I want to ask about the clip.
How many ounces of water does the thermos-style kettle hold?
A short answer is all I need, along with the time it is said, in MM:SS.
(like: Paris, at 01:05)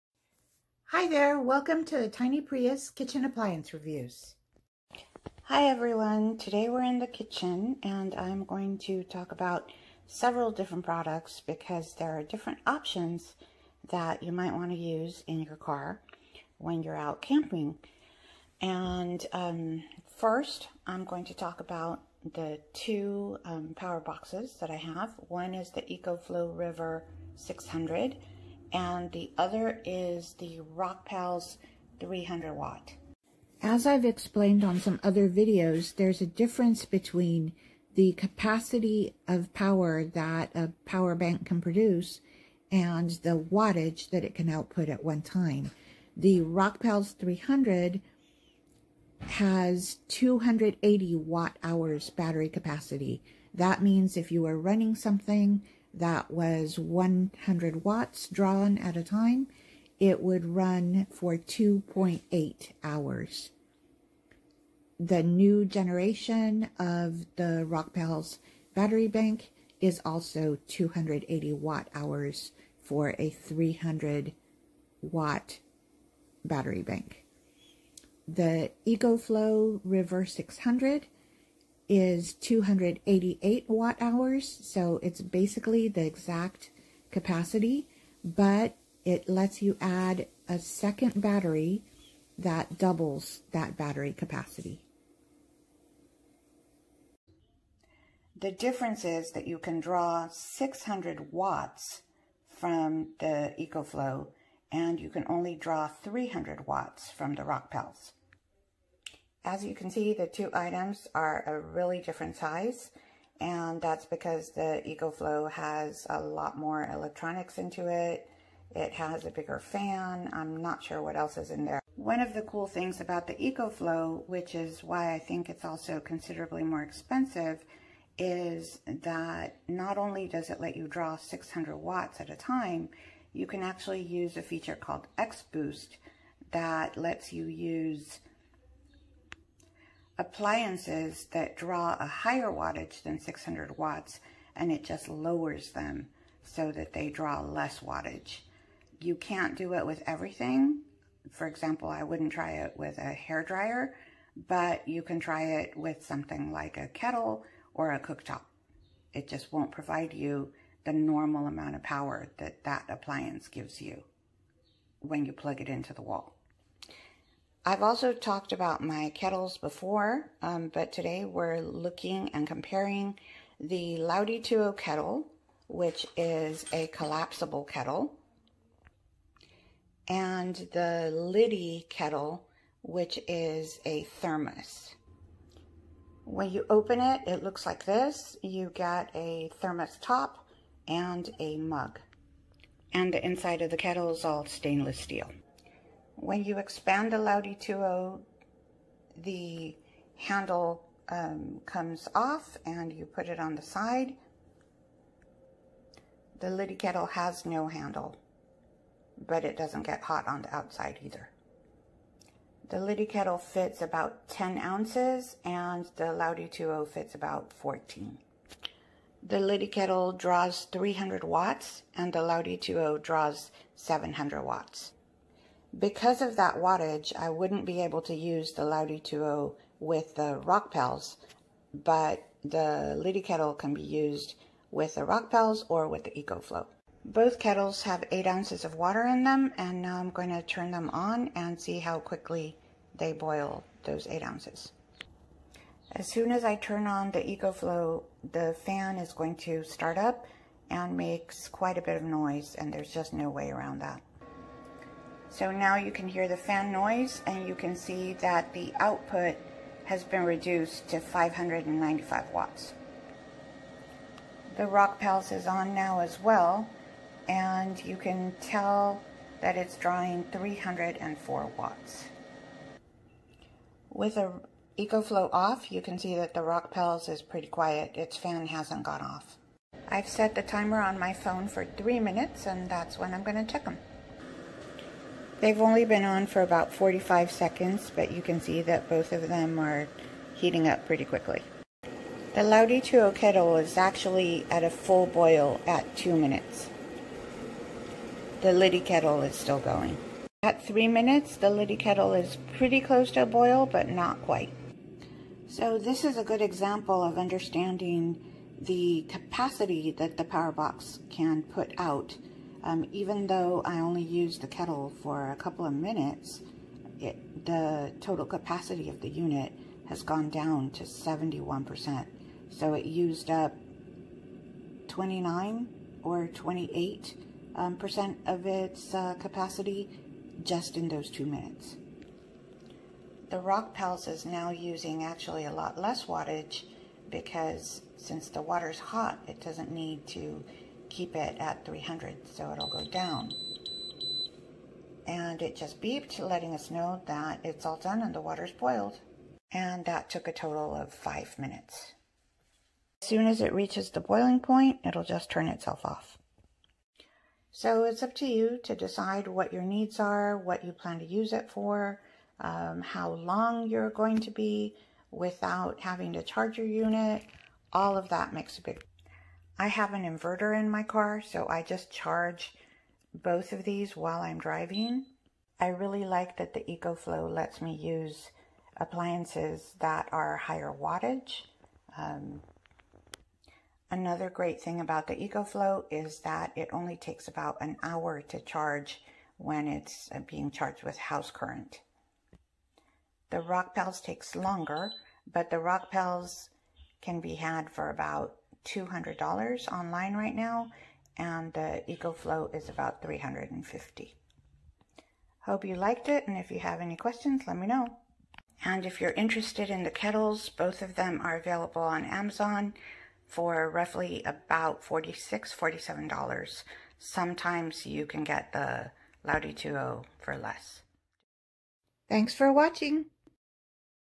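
10 ounces, at 03:33.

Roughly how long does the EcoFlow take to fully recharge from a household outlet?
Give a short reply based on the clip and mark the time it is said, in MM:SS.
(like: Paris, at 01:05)
About an hour, at 06:27.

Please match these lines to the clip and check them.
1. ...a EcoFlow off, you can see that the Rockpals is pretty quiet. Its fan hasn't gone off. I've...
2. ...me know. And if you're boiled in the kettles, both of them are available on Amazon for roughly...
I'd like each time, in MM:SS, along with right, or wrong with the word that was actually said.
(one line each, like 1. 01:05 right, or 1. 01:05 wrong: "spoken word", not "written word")
1. 04:34 right
2. 06:47 wrong: "interested", not "boiled".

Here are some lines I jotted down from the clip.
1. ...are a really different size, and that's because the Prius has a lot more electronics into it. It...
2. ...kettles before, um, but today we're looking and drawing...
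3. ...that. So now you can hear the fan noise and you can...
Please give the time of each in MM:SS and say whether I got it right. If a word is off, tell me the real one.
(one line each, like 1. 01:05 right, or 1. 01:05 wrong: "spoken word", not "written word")
1. 01:51 wrong: "EcoFlow", not "Prius"
2. 02:49 wrong: "comparing", not "drawing"
3. 04:13 right.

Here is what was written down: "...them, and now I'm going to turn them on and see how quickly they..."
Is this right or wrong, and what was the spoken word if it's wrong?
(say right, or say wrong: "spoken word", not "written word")
right.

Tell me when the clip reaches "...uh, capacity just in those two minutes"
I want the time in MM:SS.
05:28.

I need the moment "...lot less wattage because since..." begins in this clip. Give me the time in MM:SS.
05:35.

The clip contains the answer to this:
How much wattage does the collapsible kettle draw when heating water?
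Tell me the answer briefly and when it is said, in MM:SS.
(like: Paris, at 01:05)
700 watts, at 03:43.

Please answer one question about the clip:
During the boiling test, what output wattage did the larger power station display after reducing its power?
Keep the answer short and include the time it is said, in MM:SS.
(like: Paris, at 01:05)
595 watts, at 04:20.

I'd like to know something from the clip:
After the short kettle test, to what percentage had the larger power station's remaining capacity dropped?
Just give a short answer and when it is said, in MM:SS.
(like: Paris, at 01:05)
71%, at 05:20.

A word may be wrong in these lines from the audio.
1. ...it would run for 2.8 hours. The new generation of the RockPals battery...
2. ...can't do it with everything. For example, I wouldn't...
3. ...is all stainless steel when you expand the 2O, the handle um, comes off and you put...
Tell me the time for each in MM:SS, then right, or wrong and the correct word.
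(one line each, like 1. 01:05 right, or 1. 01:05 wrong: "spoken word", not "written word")
1. 00:59 right
2. 02:29 right
3. 03:14 right.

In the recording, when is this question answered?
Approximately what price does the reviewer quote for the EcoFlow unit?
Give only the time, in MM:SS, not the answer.
06:43.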